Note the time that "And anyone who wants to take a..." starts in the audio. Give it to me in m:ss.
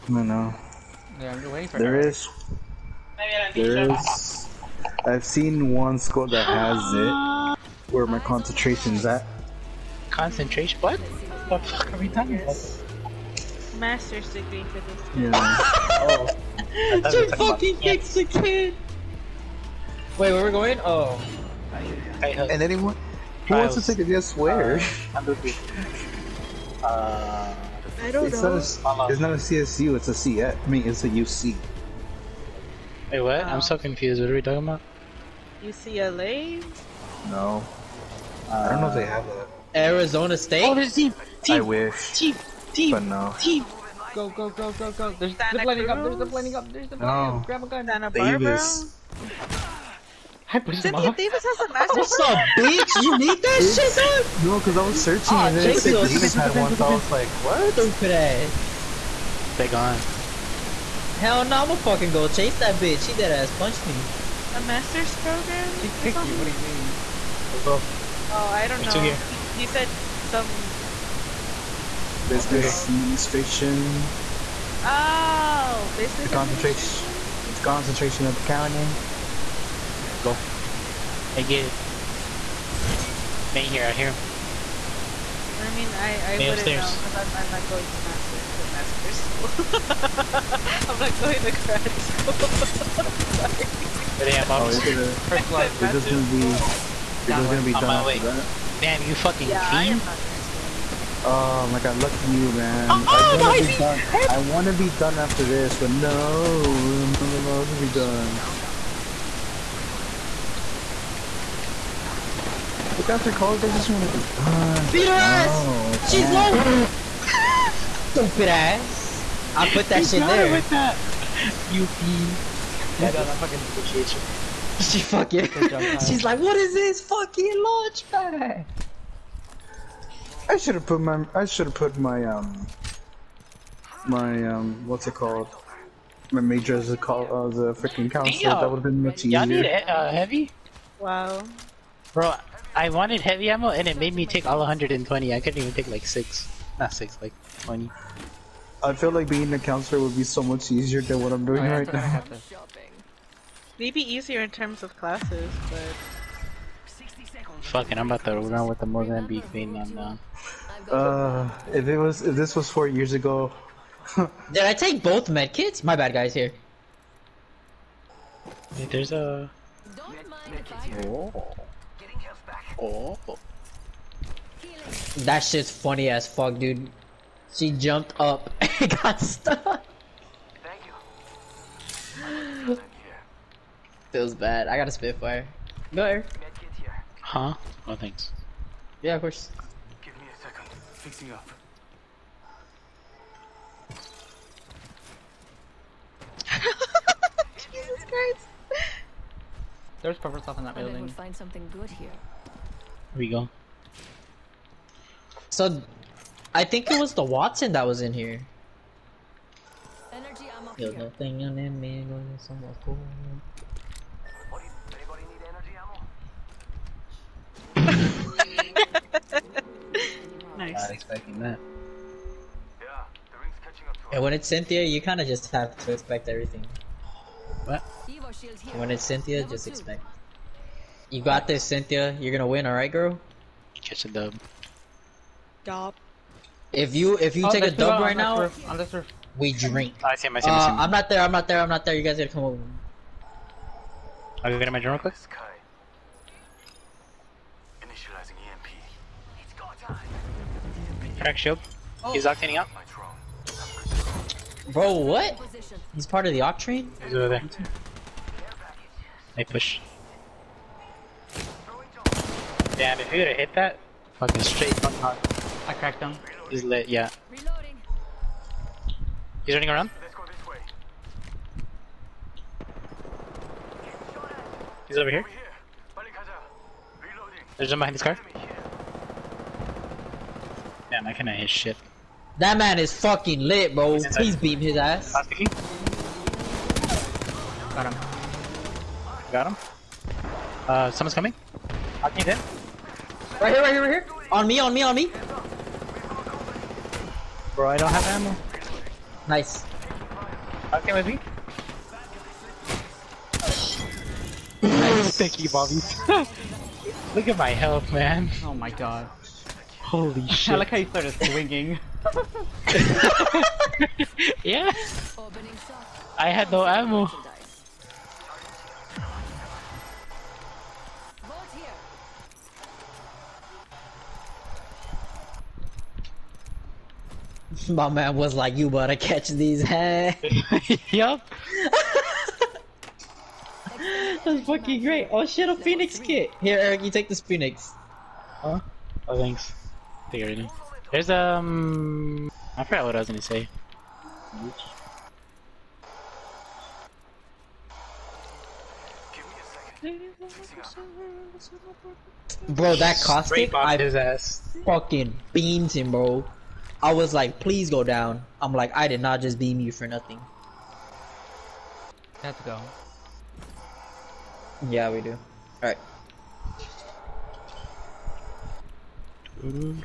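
0:22.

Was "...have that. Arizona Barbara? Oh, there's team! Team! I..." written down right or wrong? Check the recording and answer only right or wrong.
wrong.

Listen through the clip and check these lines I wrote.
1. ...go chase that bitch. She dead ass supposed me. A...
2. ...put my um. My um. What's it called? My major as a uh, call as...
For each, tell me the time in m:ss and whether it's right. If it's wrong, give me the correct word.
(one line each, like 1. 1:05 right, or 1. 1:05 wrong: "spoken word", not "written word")
1. 1:02 wrong: "punched", not "supposed"
2. 2:11 right.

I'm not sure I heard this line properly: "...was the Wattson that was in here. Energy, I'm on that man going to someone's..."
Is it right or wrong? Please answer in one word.
right.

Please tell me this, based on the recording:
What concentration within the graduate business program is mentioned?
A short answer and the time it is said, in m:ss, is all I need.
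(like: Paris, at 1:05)
Accounting, at 1:18.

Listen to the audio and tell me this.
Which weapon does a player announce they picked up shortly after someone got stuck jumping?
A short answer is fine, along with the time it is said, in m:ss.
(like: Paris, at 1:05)
Spitfire, at 3:04.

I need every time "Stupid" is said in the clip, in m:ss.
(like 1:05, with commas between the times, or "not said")
0:57, 1:58.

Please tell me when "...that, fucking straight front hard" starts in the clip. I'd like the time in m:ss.
4:23.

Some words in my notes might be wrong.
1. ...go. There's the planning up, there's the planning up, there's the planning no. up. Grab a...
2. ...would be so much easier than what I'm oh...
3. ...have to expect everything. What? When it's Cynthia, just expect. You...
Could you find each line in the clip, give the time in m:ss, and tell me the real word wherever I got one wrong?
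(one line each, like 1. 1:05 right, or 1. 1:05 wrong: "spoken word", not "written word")
1. 0:44 right
2. 2:30 right
3. 3:45 right.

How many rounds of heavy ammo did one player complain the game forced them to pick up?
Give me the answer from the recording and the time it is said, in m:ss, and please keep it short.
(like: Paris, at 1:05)
120, at 2:24.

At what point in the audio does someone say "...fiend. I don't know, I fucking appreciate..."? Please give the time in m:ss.
2:01.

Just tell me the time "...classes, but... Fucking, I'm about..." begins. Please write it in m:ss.
2:34.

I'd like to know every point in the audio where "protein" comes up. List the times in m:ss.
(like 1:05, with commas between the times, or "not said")
not said.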